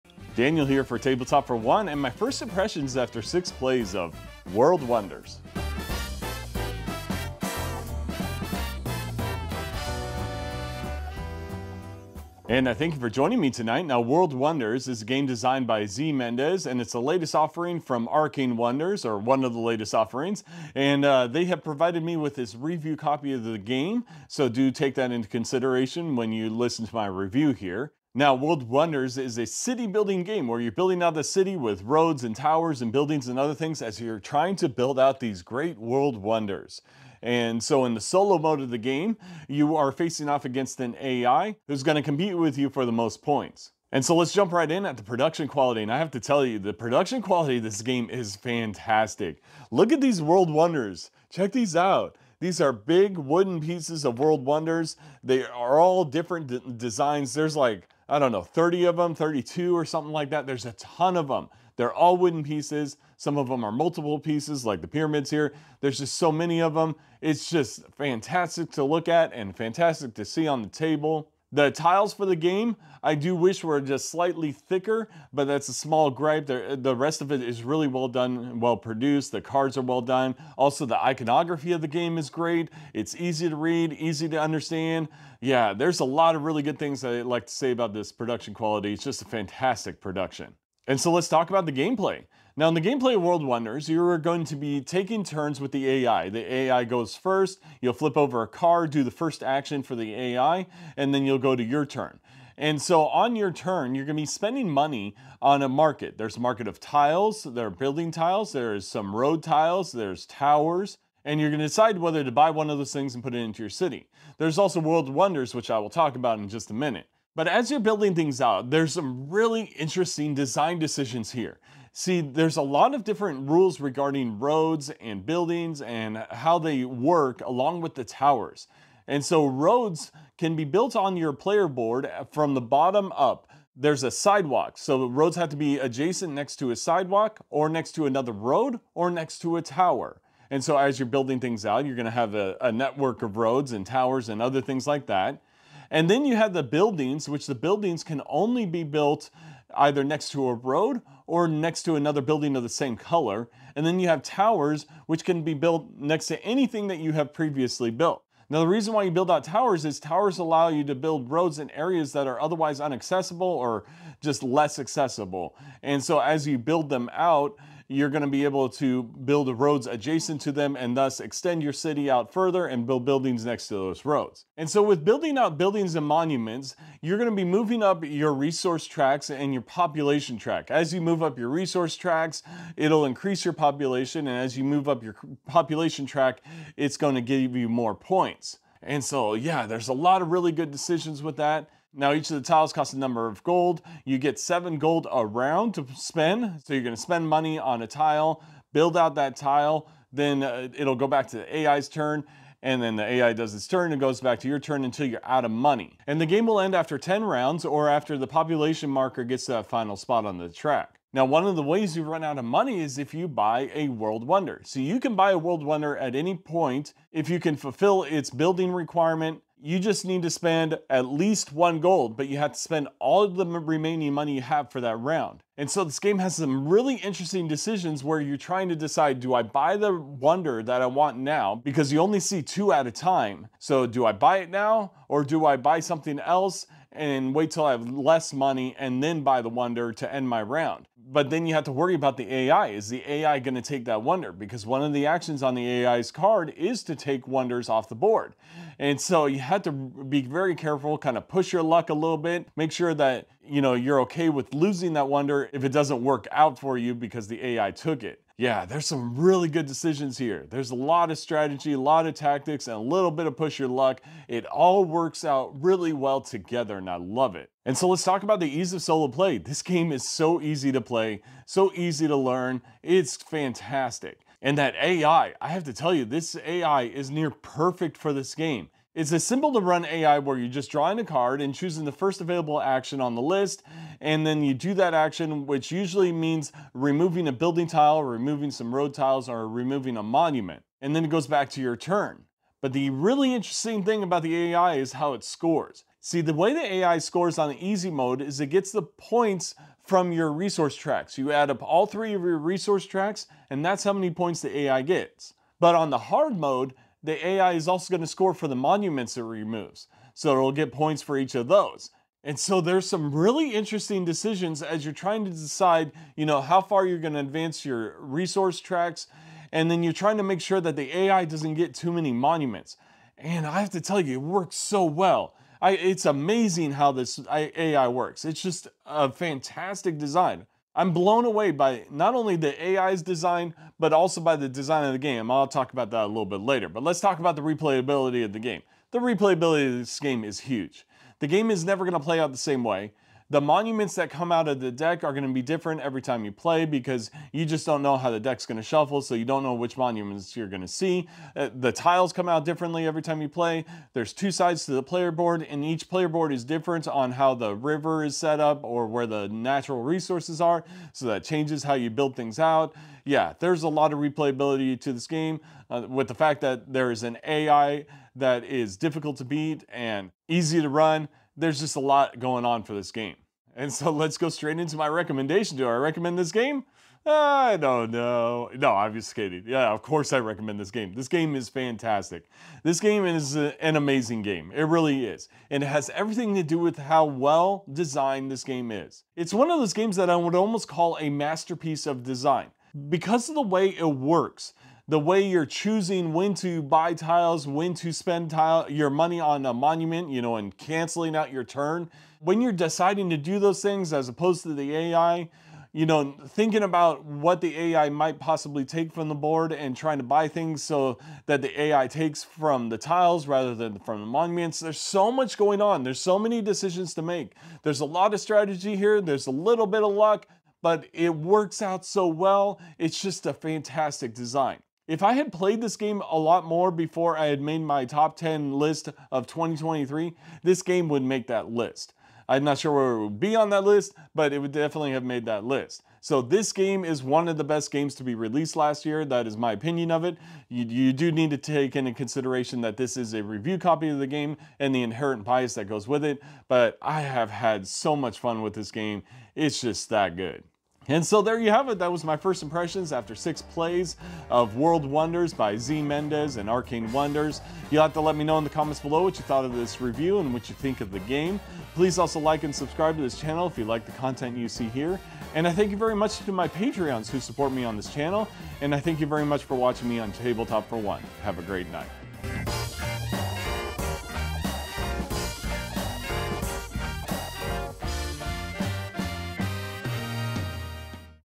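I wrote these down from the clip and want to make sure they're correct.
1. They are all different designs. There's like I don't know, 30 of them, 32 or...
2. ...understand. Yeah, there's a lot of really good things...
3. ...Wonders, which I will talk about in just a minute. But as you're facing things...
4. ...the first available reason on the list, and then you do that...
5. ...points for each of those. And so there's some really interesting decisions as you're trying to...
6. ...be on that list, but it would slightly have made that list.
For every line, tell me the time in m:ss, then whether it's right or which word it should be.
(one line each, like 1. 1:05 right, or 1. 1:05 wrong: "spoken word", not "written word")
1. 0:55 right
2. 1:24 right
3. 1:55 wrong: "building", not "facing"
4. 4:41 wrong: "action", not "reason"
5. 5:10 right
6. 7:13 wrong: "definitely", not "slightly".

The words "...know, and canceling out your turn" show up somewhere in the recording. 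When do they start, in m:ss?
6:40.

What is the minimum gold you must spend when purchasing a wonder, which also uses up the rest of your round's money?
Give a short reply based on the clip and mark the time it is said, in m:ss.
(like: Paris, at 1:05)
1, at 3:41.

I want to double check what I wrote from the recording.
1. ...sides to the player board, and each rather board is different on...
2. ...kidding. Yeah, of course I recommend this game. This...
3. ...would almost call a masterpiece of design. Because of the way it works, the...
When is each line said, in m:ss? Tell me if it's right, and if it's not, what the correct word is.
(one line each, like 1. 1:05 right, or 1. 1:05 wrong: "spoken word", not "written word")
1. 5:54 wrong: "player", not "rather"
2. 6:19 right
3. 6:30 right.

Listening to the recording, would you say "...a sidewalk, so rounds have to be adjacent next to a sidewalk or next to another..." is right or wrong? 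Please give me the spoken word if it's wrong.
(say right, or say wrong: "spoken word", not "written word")
wrong: "roads", not "rounds".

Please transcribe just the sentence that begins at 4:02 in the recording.
Is the AI going to take that wonder?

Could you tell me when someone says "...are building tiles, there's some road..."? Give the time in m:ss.
1:47.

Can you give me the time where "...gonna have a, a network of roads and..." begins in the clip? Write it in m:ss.
2:21.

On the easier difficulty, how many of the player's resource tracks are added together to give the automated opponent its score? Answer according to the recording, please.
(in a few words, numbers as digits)
3.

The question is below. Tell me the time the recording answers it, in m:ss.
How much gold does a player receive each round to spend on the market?
3:14.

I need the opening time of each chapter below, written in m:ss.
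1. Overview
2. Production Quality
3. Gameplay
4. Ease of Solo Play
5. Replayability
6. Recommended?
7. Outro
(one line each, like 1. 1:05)
1. 0:12
2. 0:43
3. 1:30
4. 4:27
5. 5:36
6. 6:13
7. 7:30.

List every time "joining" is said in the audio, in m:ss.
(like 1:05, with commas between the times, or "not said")
0:13.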